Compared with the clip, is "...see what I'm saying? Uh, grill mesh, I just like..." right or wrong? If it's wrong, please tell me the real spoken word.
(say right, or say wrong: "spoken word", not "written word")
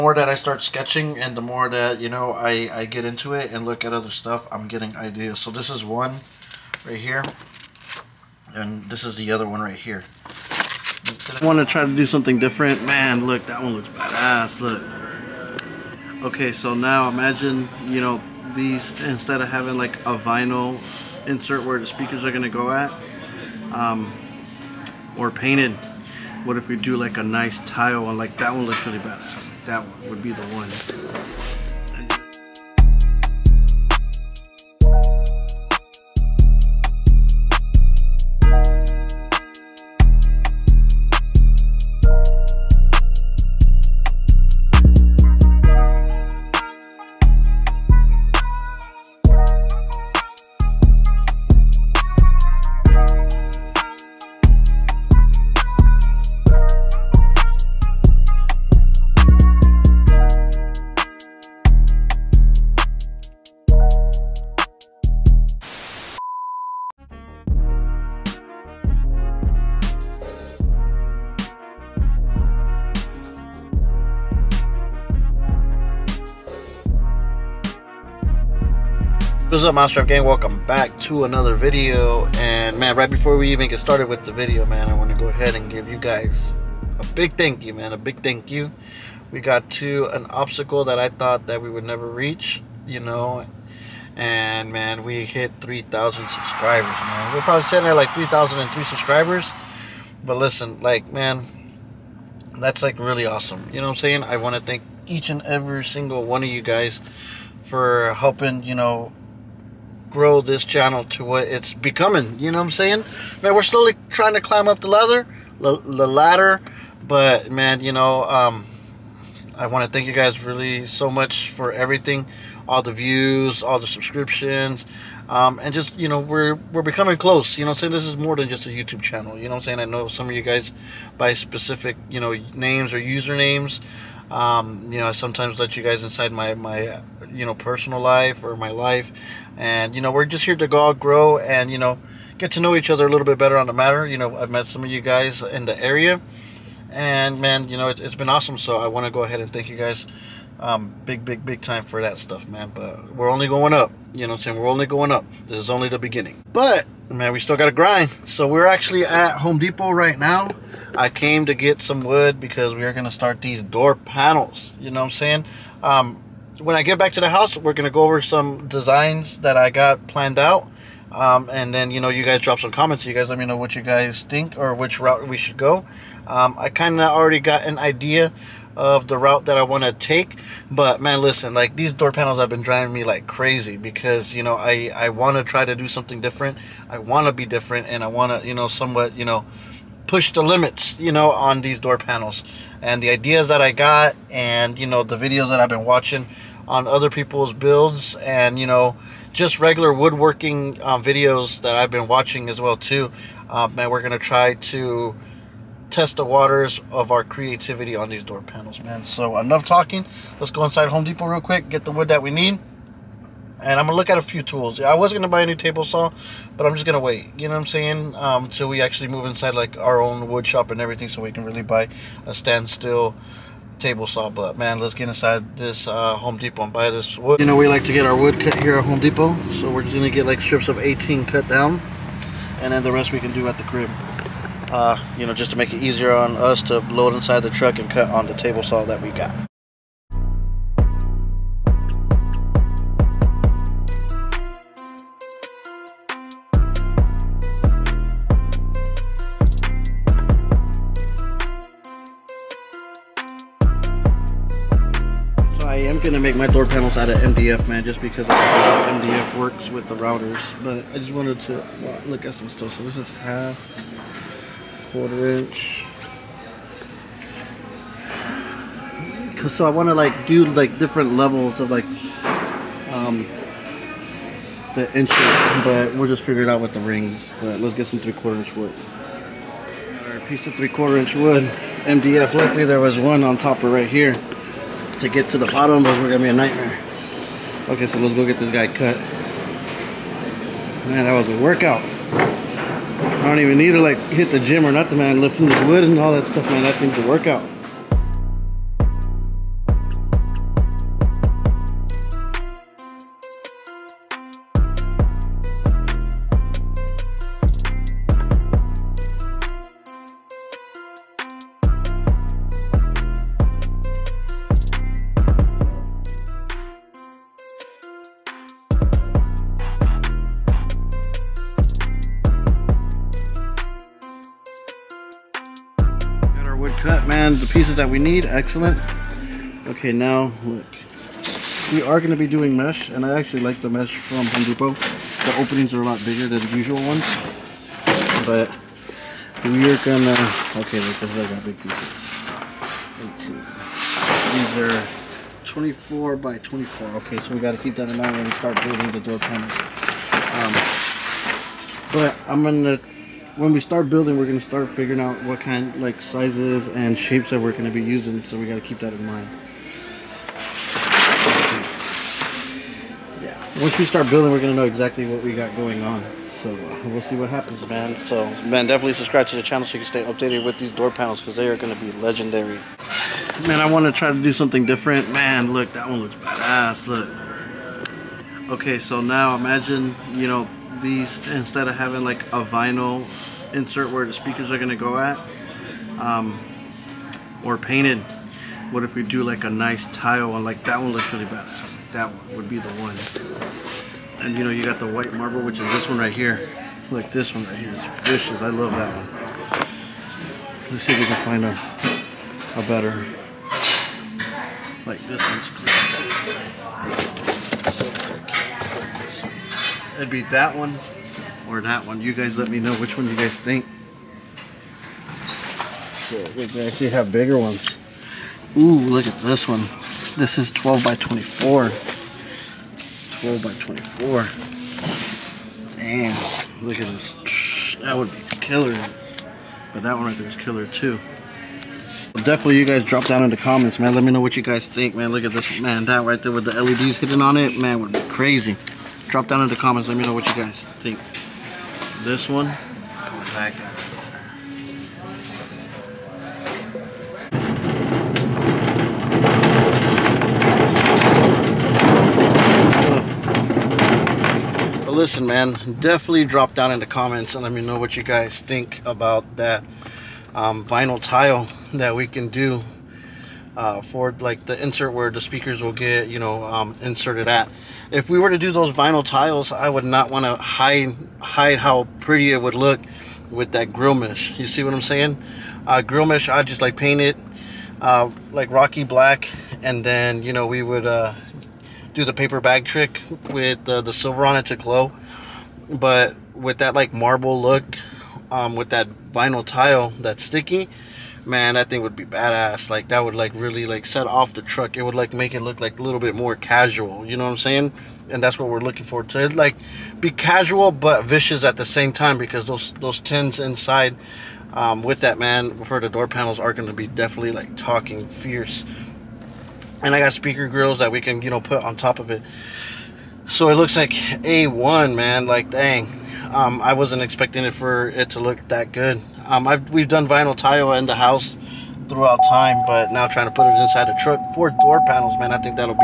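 right.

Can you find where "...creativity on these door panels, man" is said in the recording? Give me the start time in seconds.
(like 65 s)
207 s.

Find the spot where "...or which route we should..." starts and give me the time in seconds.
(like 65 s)
174 s.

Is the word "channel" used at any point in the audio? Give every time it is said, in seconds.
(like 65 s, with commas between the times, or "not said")
110 s, 128 s, 369 s.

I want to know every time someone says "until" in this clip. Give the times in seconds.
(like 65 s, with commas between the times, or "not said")
218 s.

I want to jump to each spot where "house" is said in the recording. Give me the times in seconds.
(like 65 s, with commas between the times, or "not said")
167 s, 520 s.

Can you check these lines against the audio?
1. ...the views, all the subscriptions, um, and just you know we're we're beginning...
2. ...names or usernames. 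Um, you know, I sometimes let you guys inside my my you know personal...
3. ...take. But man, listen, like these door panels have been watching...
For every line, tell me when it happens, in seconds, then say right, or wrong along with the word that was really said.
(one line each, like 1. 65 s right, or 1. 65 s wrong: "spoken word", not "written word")
1. 122 s wrong: "becoming", not "beginning"
2. 132 s right
3. 179 s wrong: "driving", not "watching".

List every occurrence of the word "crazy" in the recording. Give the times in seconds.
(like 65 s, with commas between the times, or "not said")
183 s, 438 s.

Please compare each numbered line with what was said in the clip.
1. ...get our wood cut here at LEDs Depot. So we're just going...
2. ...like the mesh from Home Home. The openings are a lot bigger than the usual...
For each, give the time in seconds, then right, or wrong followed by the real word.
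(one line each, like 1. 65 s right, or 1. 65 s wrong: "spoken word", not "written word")
1. 227 s wrong: "Home", not "LEDs"
2. 333 s wrong: "Depot", not "Home".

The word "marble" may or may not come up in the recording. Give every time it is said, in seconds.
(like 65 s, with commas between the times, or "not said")
395 s, 486 s.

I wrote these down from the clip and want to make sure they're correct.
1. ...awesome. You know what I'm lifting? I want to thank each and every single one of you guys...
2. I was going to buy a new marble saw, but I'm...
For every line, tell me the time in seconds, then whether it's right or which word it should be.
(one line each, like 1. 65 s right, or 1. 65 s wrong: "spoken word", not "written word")
1. 103 s wrong: "saying", not "lifting"
2. 214 s wrong: "table", not "marble".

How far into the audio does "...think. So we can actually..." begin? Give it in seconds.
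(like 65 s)
413 s.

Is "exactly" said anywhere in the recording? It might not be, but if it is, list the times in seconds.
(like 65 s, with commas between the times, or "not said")
364 s.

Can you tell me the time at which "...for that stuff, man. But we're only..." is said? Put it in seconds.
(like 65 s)
151 s.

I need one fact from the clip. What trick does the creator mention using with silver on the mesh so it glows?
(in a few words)
paper bag trick.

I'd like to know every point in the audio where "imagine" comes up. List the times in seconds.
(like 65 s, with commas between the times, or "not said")
17 s, 379 s.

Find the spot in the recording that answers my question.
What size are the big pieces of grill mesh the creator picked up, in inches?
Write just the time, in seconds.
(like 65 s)
345 s.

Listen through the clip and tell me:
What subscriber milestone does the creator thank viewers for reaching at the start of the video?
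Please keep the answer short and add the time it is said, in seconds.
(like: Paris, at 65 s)
3,000, at 95 s.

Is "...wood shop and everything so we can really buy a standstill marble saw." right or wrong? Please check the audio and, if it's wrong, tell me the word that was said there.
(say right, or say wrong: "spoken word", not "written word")
wrong: "table", not "marble".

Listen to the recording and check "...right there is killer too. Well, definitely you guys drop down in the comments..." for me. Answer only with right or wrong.
right.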